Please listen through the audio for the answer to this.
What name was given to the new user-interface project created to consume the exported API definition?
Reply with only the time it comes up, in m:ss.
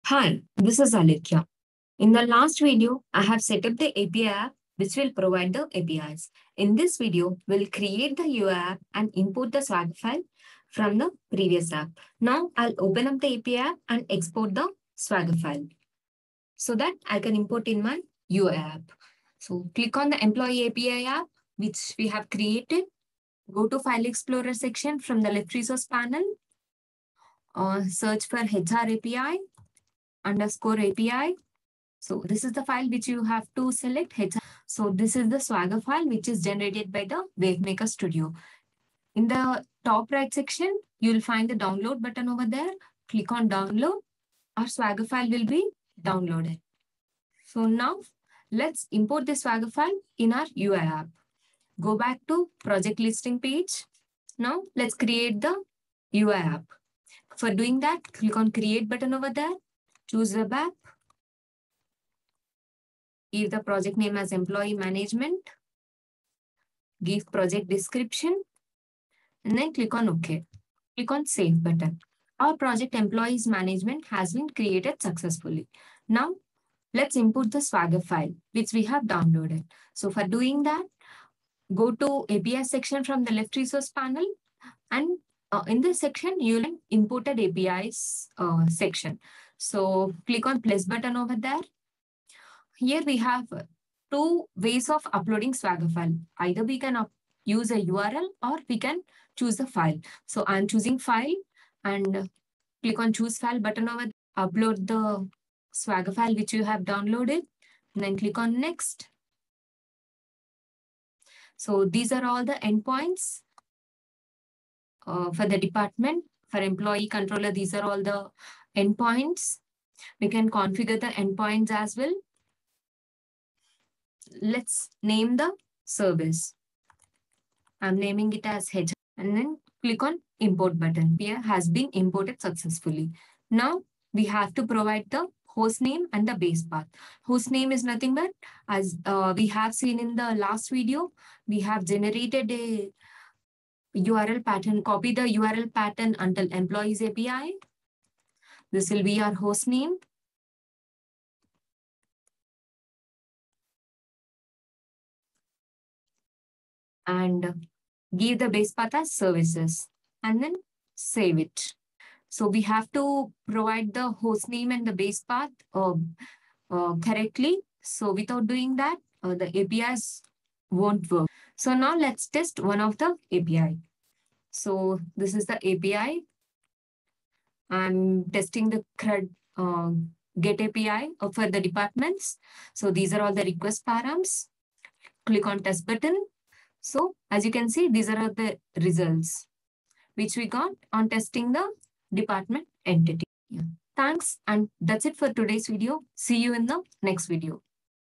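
1:04.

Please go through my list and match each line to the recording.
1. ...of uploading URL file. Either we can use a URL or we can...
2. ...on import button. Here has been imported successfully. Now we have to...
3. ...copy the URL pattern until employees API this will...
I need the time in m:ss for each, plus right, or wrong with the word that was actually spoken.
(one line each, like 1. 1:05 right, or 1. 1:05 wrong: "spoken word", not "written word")
1. 1:34 wrong: "Swagger", not "URL"
2. 2:10 right
3. 2:24 right.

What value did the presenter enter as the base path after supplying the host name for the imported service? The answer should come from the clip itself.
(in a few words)
services.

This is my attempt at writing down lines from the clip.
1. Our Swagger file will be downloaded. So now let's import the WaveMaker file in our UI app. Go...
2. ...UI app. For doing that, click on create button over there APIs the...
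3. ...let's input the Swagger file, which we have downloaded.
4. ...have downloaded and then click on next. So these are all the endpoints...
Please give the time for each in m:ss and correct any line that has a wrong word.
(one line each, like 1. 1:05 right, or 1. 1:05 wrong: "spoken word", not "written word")
1. 0:44 wrong: "Swagger", not "WaveMaker"
2. 0:56 wrong: "Choose", not "APIs"
3. 1:16 right
4. 1:46 right.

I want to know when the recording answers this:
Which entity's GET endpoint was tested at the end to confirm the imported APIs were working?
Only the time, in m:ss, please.
3:01.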